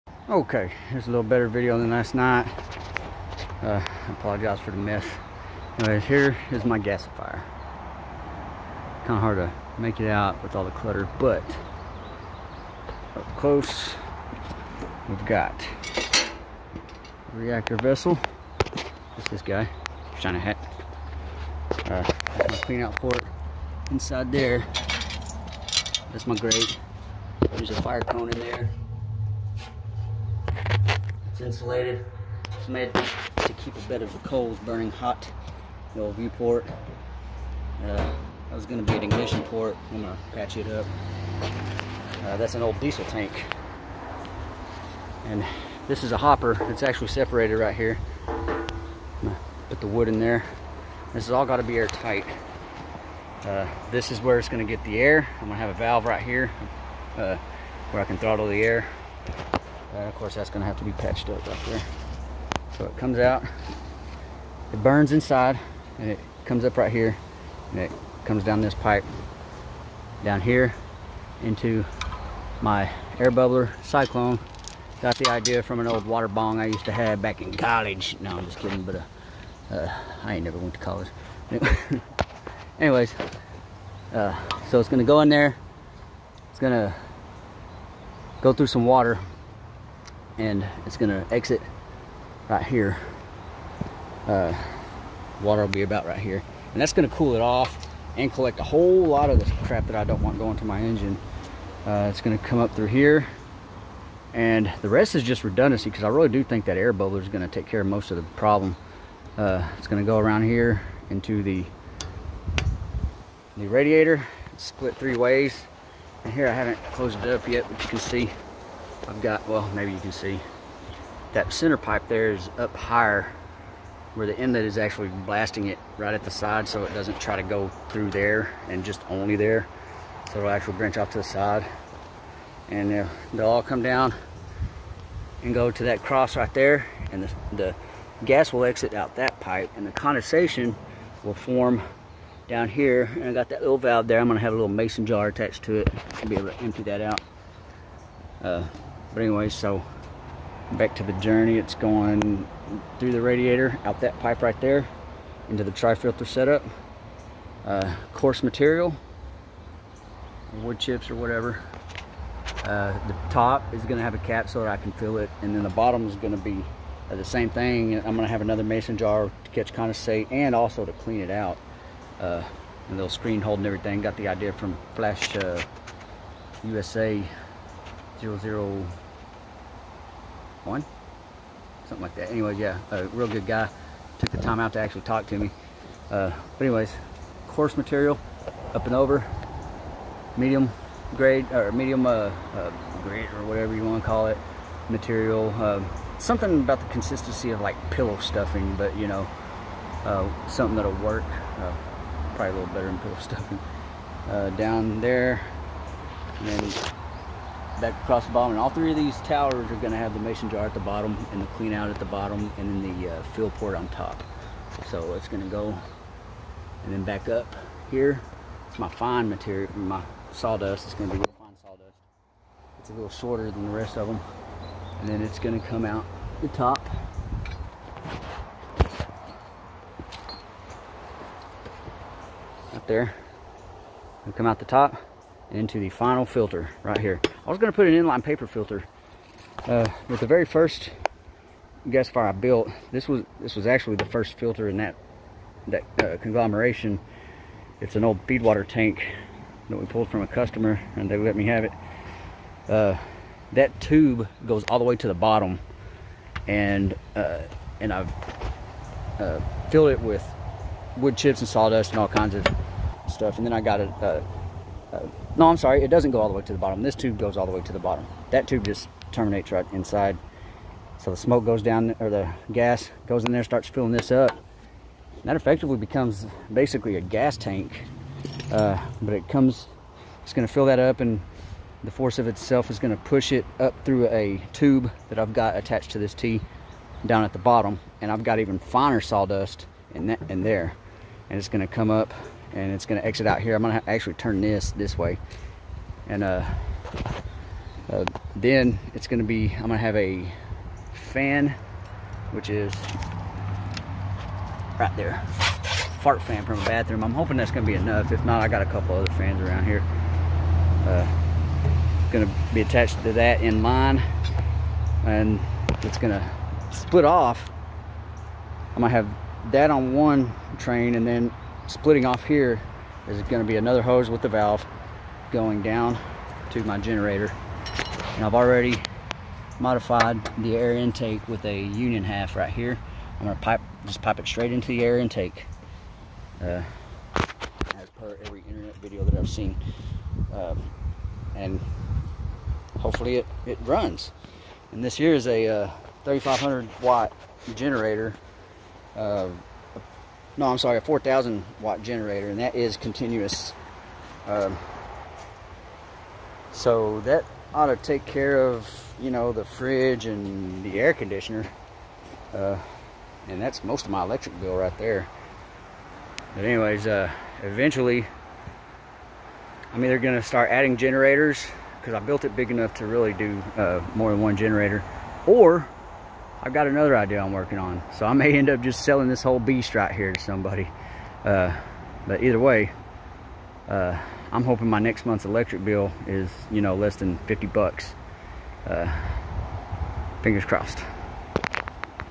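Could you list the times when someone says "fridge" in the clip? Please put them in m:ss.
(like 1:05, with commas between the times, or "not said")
5:59.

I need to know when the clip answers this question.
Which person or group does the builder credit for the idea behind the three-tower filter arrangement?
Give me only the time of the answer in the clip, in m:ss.
2:54.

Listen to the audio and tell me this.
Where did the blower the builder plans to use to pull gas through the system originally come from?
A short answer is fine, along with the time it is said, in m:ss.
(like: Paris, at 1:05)
A bathroom, at 5:06.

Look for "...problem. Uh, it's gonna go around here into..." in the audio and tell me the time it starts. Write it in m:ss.
1:48.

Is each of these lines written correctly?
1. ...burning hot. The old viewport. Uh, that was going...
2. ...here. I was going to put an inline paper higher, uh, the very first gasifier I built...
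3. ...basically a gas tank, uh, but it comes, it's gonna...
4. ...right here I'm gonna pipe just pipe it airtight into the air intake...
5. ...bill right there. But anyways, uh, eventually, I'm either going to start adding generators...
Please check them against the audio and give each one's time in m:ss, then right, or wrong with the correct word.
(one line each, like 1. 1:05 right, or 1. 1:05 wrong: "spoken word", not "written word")
1. 0:34 right
2. 3:56 wrong: "filter", not "higher"
3. 4:36 right
4. 5:32 wrong: "straight", not "airtight"
5. 6:04 right.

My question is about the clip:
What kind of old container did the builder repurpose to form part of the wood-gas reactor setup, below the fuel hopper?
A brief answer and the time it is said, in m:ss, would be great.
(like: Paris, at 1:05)
Diesel tank, at 0:42.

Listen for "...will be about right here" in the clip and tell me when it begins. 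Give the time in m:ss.
1:35.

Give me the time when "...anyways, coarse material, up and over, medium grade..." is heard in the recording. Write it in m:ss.
3:06.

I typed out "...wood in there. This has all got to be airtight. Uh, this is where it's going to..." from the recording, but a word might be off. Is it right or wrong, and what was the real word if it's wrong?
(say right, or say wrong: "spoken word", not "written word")
right.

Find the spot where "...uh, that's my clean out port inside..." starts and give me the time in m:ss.
0:21.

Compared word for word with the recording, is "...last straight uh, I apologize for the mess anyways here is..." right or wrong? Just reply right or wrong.
wrong.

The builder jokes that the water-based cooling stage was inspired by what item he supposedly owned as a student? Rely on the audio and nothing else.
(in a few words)
Water bong.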